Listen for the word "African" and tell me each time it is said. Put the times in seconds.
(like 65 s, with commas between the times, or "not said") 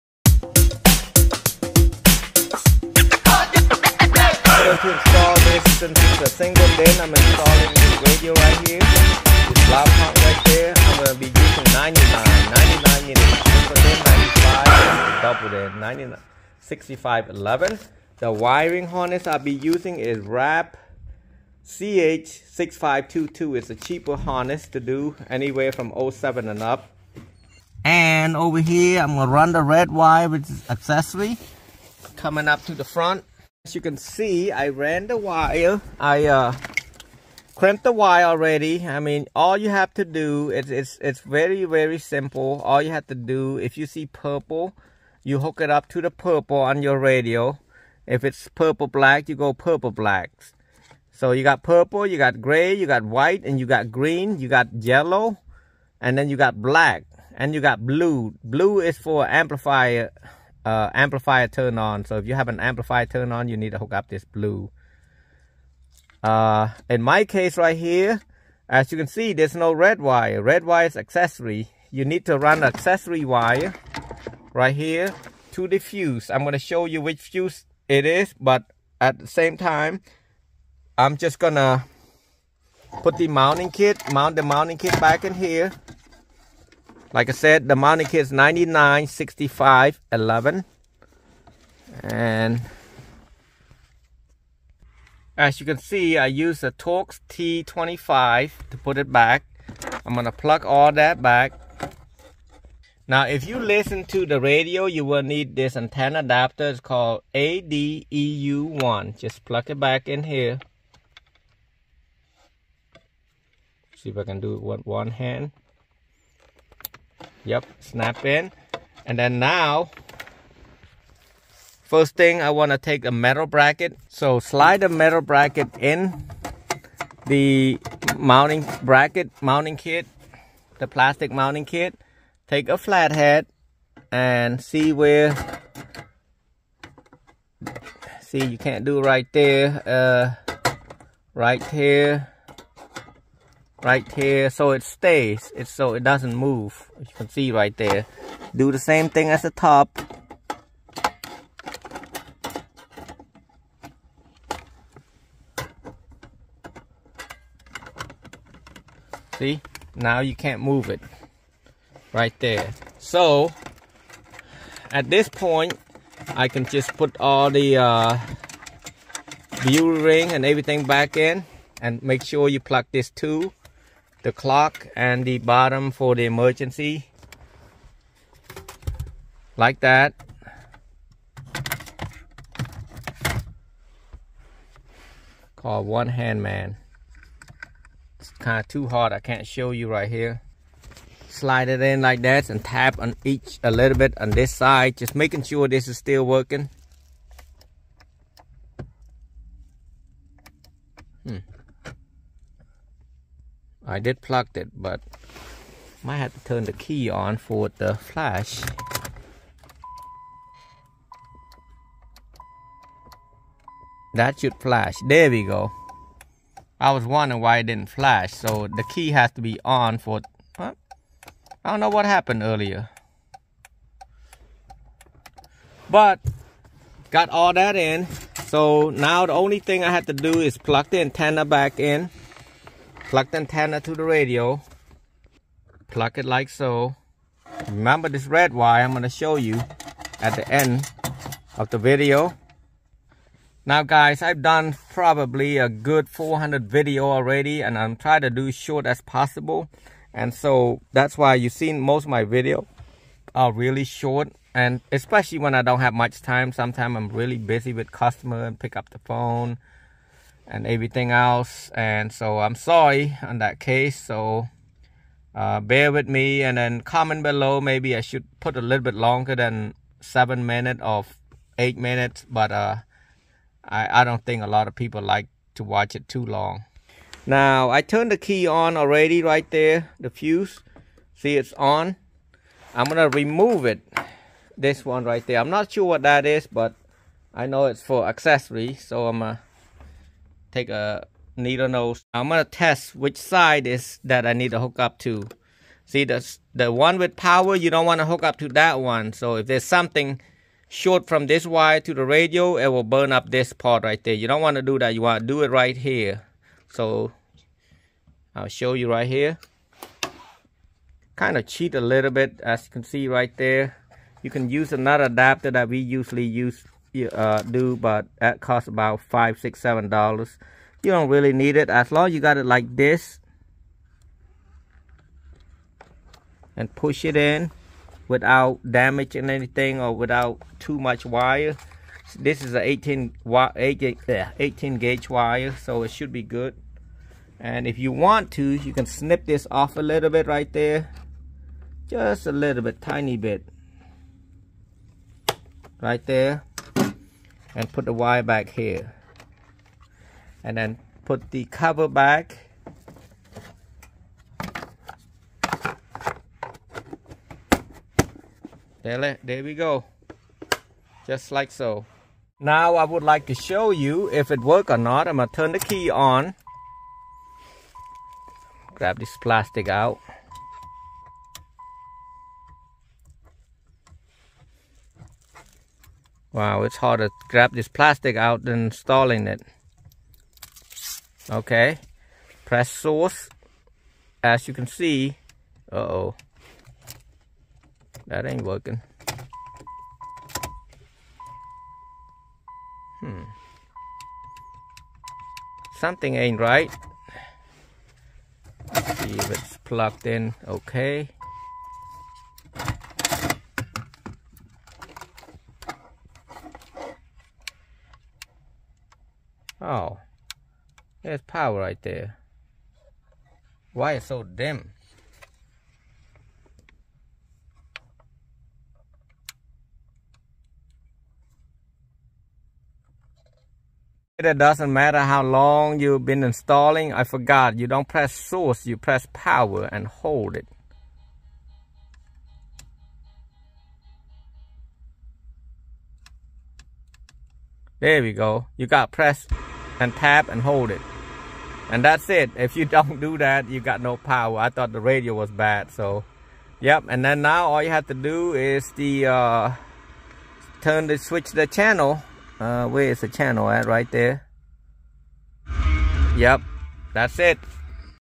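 not said.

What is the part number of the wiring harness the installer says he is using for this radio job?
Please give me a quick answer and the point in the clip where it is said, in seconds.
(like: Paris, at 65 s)
CH6522, at 21 s.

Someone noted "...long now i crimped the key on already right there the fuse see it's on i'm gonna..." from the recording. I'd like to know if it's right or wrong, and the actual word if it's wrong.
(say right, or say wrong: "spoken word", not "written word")
wrong: "turned", not "crimped".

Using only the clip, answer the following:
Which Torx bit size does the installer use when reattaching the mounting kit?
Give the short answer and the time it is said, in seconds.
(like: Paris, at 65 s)
T25, at 96 s.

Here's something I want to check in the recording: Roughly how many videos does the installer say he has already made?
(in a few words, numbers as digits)
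400.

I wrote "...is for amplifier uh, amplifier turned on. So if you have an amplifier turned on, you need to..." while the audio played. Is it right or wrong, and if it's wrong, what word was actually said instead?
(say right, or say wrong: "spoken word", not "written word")
right.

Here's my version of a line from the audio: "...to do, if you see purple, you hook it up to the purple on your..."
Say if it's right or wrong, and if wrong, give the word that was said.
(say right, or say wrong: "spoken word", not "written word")
right.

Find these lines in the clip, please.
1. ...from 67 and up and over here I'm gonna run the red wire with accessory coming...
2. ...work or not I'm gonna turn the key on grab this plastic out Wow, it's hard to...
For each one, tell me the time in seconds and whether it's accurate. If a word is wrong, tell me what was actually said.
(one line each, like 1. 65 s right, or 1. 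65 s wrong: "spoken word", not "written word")
1. 25 s wrong: "07", not "67"
2. 364 s right.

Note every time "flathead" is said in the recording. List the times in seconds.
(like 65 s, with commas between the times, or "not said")
132 s.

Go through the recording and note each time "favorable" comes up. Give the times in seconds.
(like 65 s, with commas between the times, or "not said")
not said.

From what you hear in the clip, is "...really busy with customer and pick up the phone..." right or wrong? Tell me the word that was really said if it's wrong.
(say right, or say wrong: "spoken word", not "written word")
right.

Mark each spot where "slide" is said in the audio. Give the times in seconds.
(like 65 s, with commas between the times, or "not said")
124 s, 191 s.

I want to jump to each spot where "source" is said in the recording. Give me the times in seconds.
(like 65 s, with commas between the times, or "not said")
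382 s, 428 s.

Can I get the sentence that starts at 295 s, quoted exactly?
See the the one with power, you don't want to hook up to that one.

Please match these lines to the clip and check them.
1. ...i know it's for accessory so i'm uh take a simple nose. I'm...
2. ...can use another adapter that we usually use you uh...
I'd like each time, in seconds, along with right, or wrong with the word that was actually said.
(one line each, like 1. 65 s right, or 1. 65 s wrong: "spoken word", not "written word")
1. 287 s wrong: "needle", not "simple"
2. 314 s right.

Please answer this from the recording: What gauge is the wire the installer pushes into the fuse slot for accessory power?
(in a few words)
18 gauge.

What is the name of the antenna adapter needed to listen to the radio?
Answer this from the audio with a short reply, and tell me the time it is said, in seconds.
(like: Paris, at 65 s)
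ADEU1, at 107 s.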